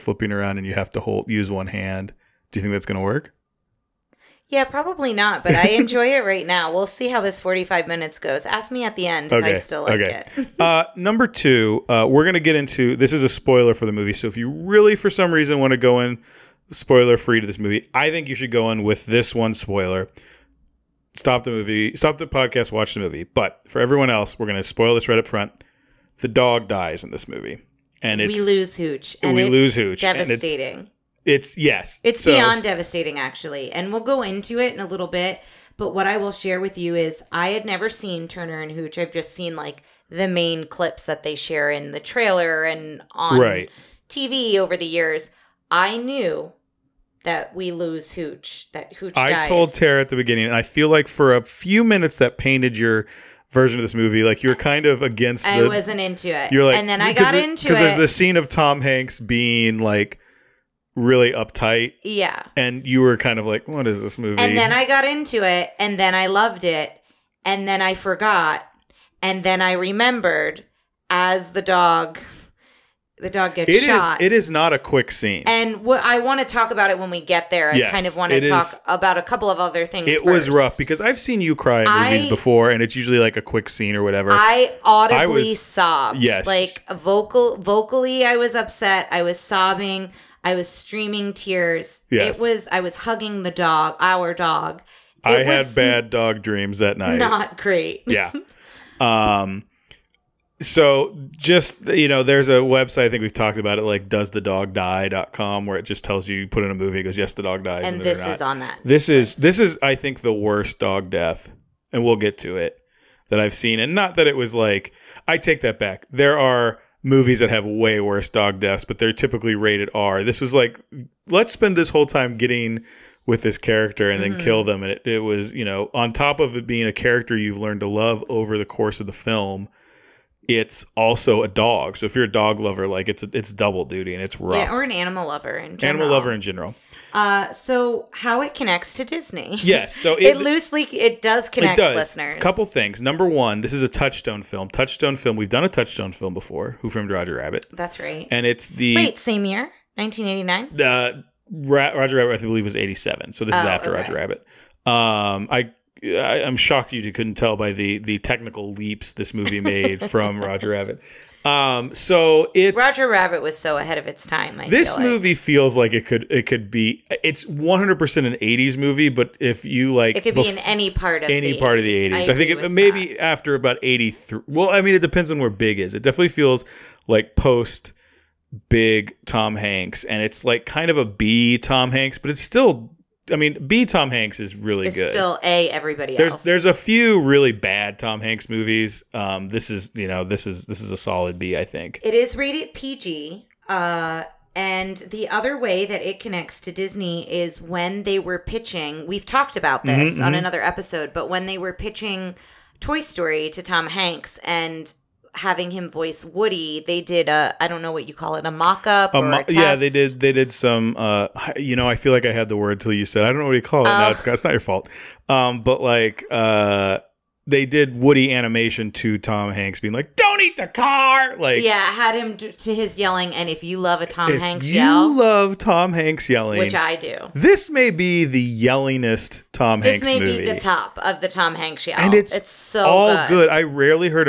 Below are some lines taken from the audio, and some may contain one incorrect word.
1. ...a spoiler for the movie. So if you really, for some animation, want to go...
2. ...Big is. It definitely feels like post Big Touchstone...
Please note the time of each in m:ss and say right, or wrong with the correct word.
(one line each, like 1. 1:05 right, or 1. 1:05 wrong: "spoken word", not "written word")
1. 0:13 wrong: "reason", not "animation"
2. 2:55 wrong: "Tom", not "Touchstone".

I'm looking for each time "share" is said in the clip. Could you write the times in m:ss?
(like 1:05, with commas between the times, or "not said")
0:36, 0:41.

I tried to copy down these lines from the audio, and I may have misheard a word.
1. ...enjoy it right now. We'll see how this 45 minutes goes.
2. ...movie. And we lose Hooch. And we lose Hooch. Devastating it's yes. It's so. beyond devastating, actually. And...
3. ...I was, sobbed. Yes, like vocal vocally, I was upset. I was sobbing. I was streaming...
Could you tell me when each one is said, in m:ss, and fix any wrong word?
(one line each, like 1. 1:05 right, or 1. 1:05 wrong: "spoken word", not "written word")
1. 0:05 right
2. 0:27 right
3. 1:25 right.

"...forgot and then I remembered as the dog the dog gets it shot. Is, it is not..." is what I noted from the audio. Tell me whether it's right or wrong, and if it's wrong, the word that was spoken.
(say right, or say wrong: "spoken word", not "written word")
right.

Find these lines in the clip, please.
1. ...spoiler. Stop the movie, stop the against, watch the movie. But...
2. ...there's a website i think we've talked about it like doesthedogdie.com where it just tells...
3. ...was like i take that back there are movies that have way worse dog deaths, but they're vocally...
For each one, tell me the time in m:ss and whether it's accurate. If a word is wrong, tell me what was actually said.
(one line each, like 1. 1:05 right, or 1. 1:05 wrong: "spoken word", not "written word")
1. 0:19 wrong: "podcast", not "against"
2. 1:42 right
3. 1:54 wrong: "typically", not "vocally".